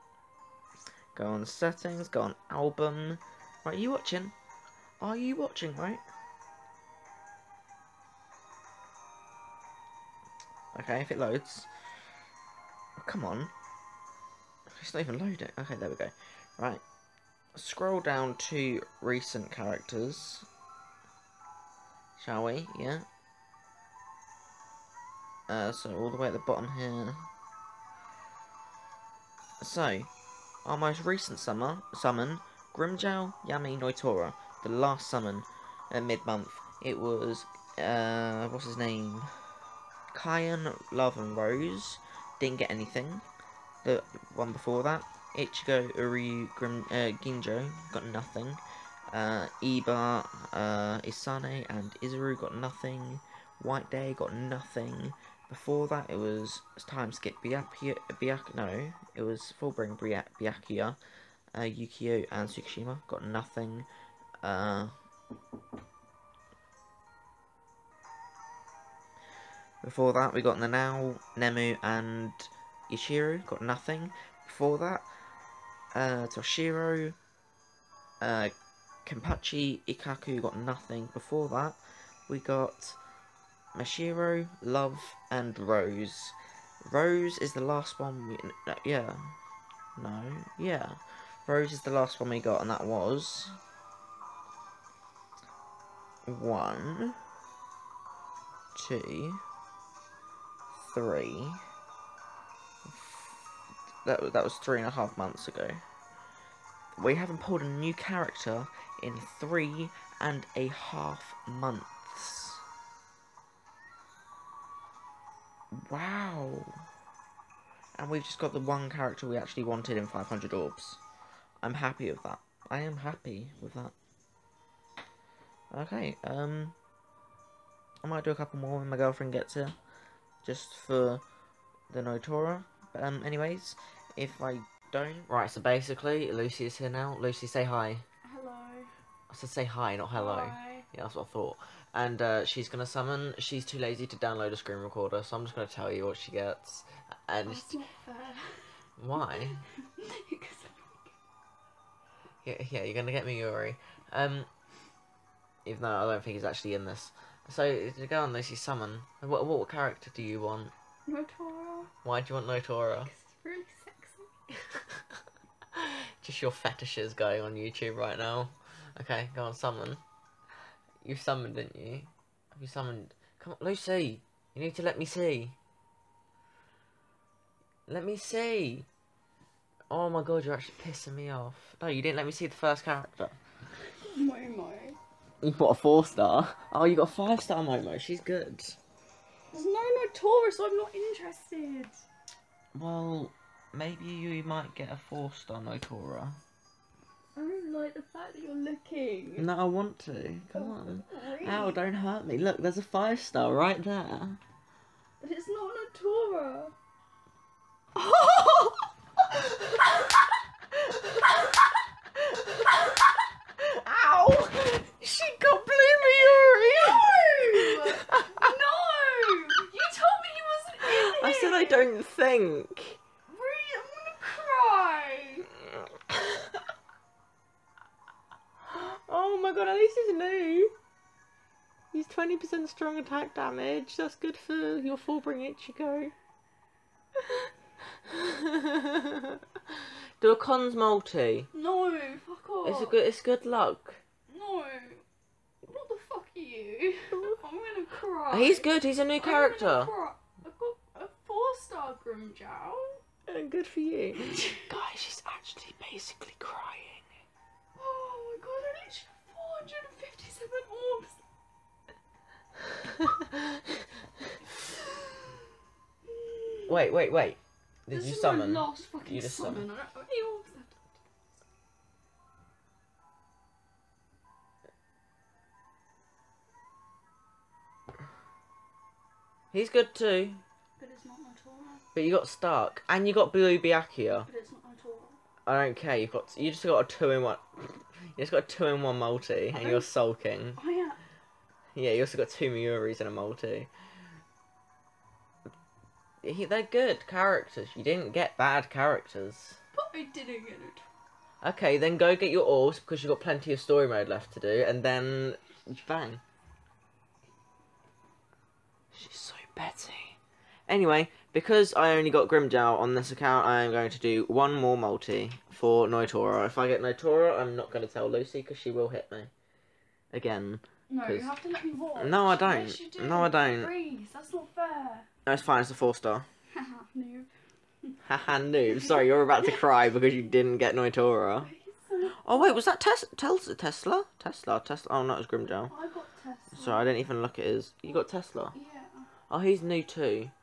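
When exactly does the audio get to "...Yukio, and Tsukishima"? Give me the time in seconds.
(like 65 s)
61 s.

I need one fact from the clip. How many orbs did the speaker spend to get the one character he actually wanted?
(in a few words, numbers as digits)
500.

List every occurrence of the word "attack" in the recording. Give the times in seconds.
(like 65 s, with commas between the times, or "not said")
232 s.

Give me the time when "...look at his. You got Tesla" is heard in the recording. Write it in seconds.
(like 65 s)
337 s.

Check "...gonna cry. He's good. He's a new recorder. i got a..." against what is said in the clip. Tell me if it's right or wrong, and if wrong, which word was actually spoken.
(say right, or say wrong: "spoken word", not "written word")
wrong: "character", not "recorder".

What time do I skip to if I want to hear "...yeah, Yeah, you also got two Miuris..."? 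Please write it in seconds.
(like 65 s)
290 s.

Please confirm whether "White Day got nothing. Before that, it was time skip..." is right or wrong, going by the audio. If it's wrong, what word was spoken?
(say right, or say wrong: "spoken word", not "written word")
right.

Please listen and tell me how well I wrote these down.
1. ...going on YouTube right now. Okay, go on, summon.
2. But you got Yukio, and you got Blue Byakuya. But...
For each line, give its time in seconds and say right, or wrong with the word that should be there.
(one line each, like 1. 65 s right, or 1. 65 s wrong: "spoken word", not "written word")
1. 167 s right
2. 281 s wrong: "Stark", not "Yukio".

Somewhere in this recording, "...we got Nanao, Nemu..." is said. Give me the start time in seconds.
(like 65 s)
70 s.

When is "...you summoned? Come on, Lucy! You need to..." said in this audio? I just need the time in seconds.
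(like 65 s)
172 s.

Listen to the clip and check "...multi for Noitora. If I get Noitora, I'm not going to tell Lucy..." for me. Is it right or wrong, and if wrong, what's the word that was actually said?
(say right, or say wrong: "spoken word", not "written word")
right.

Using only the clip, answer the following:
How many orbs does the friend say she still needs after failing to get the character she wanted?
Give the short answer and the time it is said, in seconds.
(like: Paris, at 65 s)
157, at 259 s.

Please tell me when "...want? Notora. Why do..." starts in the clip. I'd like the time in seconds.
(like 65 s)
160 s.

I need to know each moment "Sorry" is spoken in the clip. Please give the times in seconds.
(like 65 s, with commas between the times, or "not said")
328 s, 336 s.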